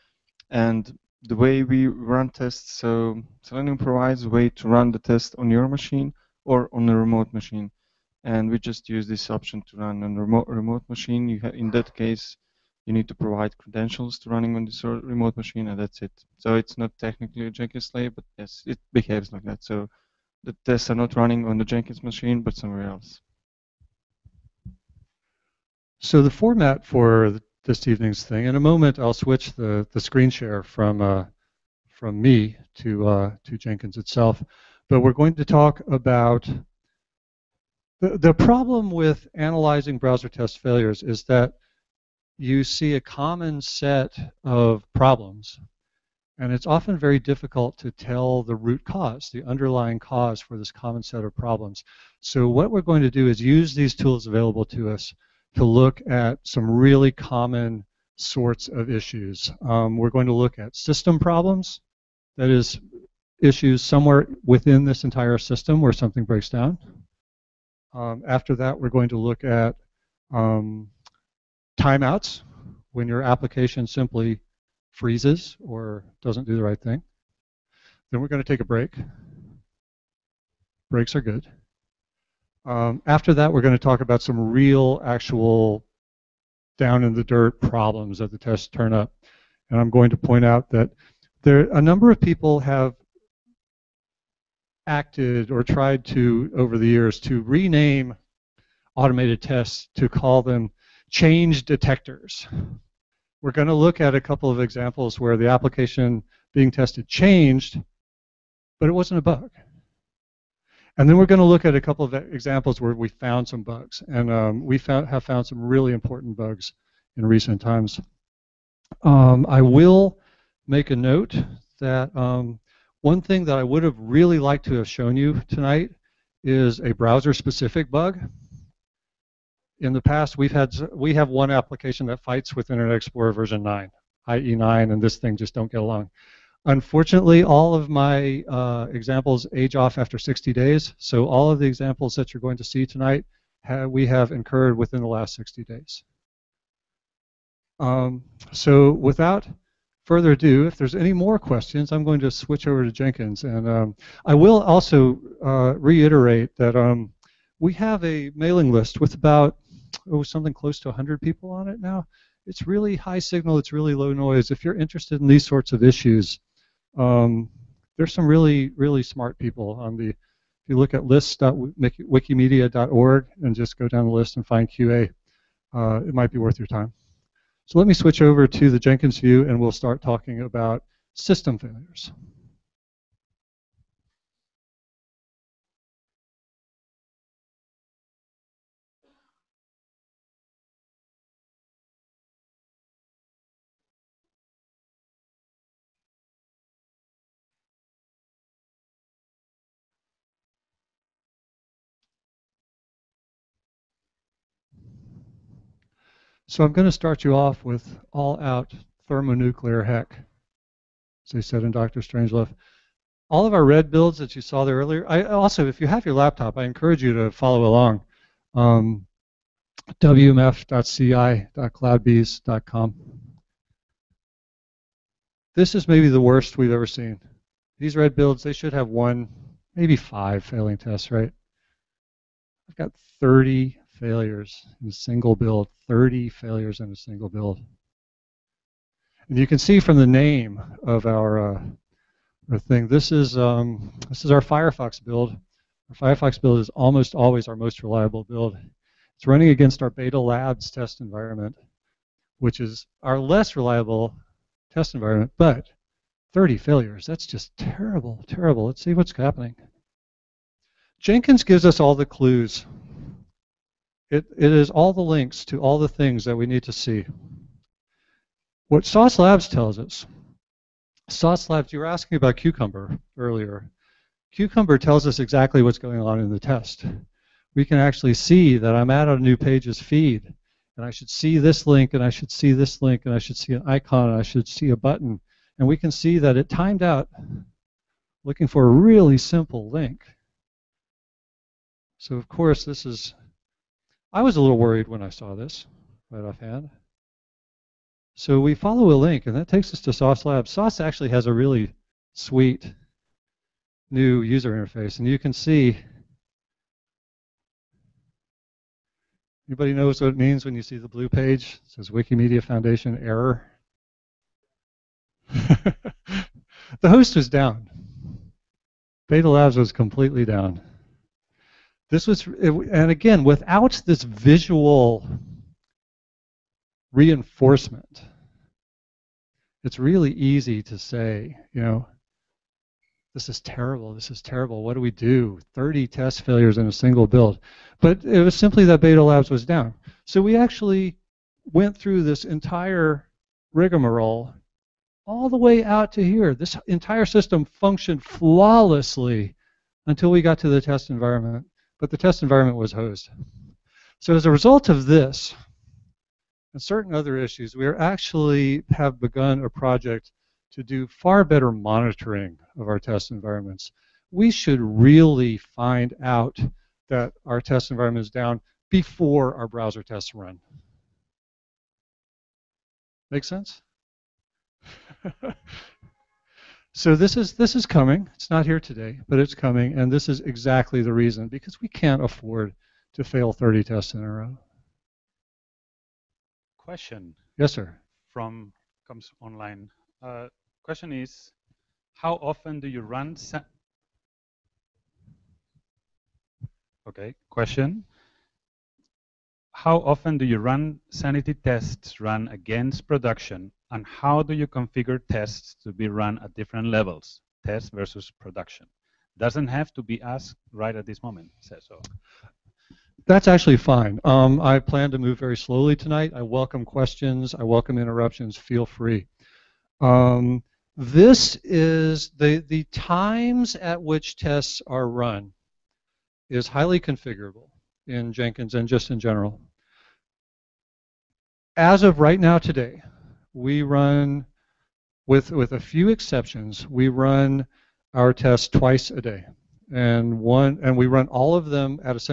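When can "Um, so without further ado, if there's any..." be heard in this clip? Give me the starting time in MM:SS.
02:27.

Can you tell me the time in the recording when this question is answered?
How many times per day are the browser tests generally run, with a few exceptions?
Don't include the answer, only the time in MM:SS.
07:18.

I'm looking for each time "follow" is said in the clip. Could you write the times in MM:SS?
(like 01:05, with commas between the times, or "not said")
03:37, 04:58.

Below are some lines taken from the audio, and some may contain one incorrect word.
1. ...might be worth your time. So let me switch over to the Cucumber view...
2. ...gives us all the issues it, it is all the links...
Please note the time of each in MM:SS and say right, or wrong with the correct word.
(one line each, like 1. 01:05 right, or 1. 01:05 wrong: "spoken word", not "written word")
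1. 02:56 wrong: "Jenkins", not "Cucumber"
2. 04:21 wrong: "clues", not "issues".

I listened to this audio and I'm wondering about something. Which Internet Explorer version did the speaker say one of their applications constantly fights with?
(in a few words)
IE 9.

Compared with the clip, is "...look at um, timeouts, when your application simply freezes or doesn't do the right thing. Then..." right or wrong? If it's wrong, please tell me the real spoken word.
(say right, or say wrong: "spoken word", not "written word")
right.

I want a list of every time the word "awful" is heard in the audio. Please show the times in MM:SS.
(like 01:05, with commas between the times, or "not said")
not said.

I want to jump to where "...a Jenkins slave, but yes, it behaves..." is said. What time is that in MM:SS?
00:17.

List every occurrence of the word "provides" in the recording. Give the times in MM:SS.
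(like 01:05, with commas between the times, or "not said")
00:03, 00:13.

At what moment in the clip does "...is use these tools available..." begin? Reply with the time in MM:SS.
00:53.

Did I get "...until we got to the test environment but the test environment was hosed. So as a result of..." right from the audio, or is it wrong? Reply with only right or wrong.
right.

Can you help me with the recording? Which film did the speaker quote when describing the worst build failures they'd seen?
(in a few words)
Dr. Strangelove.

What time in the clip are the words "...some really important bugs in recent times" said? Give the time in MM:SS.
01:55.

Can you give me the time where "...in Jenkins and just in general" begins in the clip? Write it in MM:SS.
07:07.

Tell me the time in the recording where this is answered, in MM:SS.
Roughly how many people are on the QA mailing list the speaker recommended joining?
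02:40.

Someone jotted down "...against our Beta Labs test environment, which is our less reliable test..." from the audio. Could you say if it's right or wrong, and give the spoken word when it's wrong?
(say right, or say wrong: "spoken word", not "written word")
right.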